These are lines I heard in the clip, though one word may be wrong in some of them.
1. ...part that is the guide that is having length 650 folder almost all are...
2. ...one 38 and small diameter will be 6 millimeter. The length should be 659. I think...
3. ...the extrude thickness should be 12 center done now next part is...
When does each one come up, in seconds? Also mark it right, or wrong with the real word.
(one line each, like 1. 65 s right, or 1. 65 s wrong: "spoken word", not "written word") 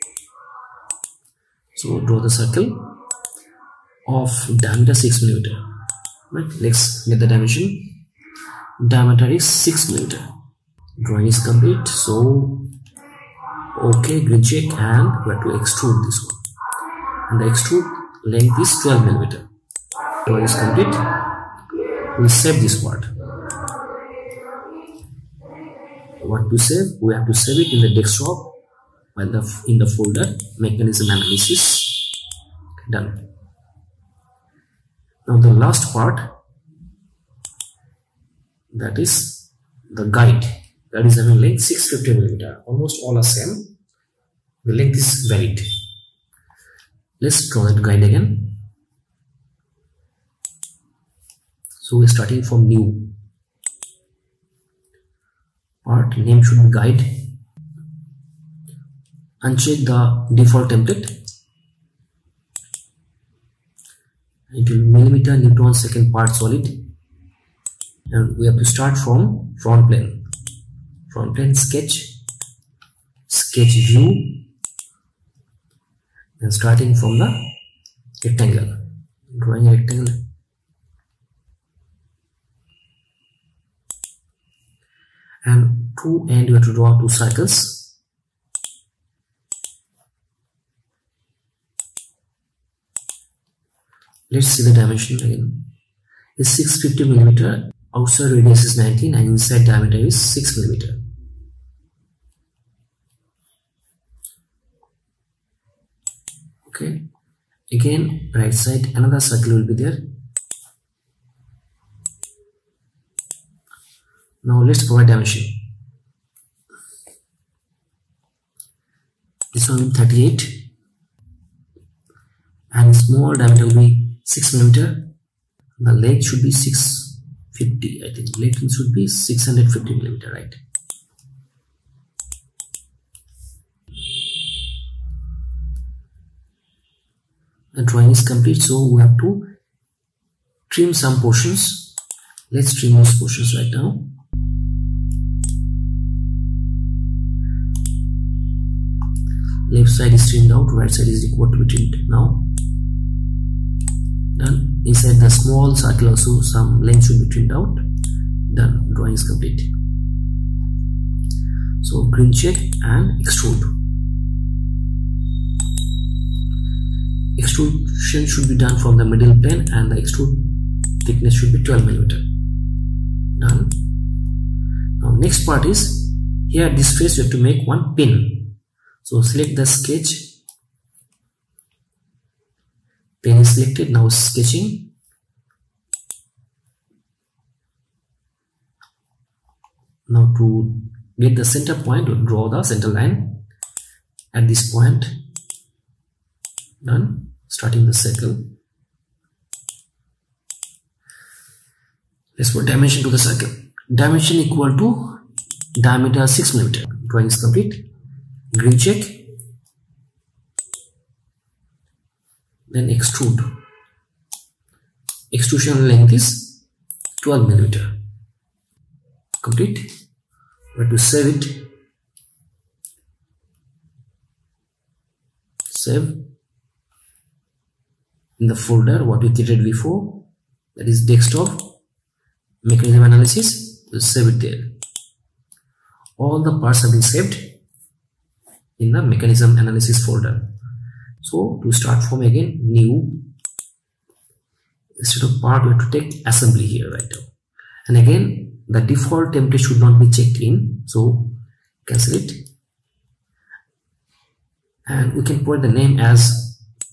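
1. 35 s wrong: "millimeter", not "folder"
2. 119 s wrong: "650", not "659"
3. 169 s wrong: "millimeter", not "center".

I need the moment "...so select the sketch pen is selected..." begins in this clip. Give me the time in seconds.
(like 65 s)
179 s.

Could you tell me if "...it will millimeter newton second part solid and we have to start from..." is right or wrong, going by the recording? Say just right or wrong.
right.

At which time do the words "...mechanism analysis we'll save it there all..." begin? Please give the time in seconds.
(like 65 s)
232 s.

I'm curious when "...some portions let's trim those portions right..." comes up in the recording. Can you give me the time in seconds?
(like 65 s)
140 s.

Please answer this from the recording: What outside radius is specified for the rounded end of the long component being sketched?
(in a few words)
19.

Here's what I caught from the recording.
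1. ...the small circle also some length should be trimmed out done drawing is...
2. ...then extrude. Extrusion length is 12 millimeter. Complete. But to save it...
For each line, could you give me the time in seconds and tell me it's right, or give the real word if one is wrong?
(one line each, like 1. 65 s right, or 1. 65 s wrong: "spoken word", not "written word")
1. 155 s right
2. 212 s right.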